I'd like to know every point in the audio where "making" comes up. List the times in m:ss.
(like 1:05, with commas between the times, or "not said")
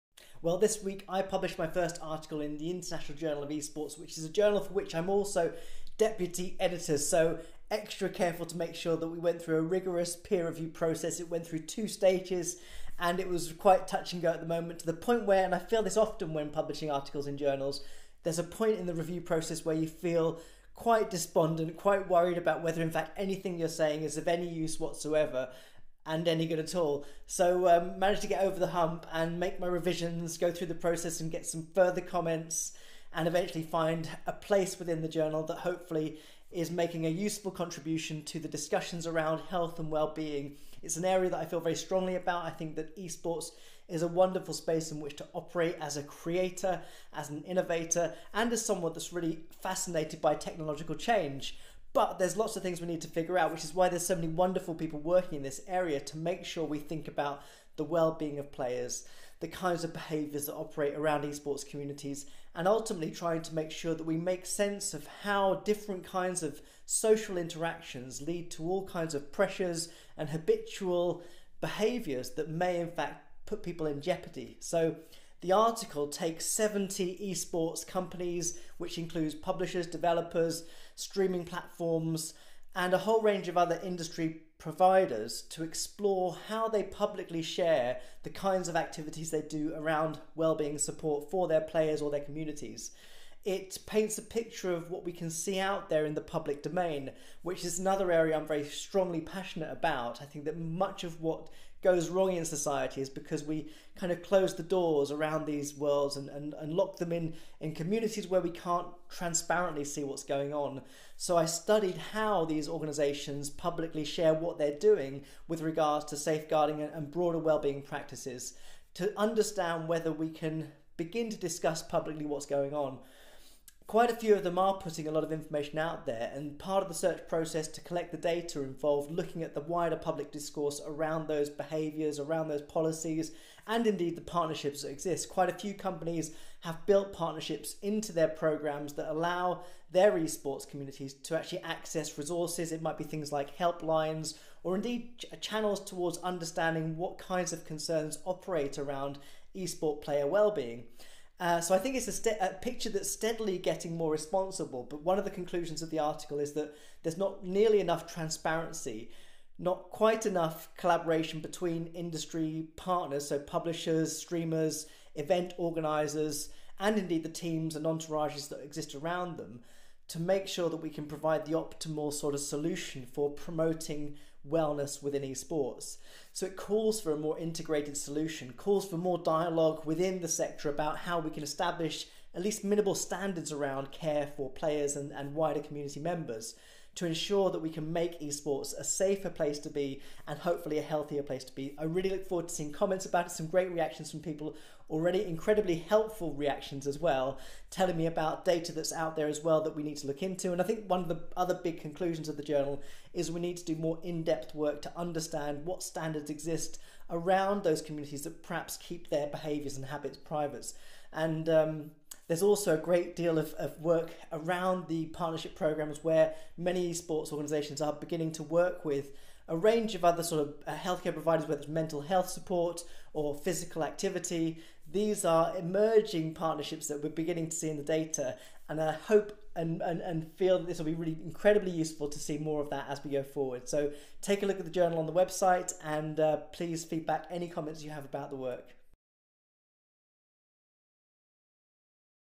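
0:36.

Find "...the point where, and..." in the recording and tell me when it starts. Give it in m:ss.
0:14.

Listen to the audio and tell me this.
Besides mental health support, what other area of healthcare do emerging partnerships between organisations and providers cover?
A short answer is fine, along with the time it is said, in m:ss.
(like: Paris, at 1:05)
physical activity, at 3:43.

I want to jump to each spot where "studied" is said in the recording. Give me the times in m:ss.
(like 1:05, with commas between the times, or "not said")
1:51.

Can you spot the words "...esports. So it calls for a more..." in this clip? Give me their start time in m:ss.
2:55.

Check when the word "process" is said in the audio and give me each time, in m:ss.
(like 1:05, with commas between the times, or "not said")
0:10, 0:19, 0:30, 2:07.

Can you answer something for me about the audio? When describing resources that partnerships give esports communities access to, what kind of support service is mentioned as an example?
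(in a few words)
helplines.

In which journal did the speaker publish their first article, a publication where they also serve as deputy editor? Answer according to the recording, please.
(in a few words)
International Journal of Esports.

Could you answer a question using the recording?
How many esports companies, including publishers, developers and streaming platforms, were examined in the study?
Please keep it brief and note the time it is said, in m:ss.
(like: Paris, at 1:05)
70, at 1:16.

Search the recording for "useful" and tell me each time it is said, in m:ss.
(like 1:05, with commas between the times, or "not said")
0:37, 3:51.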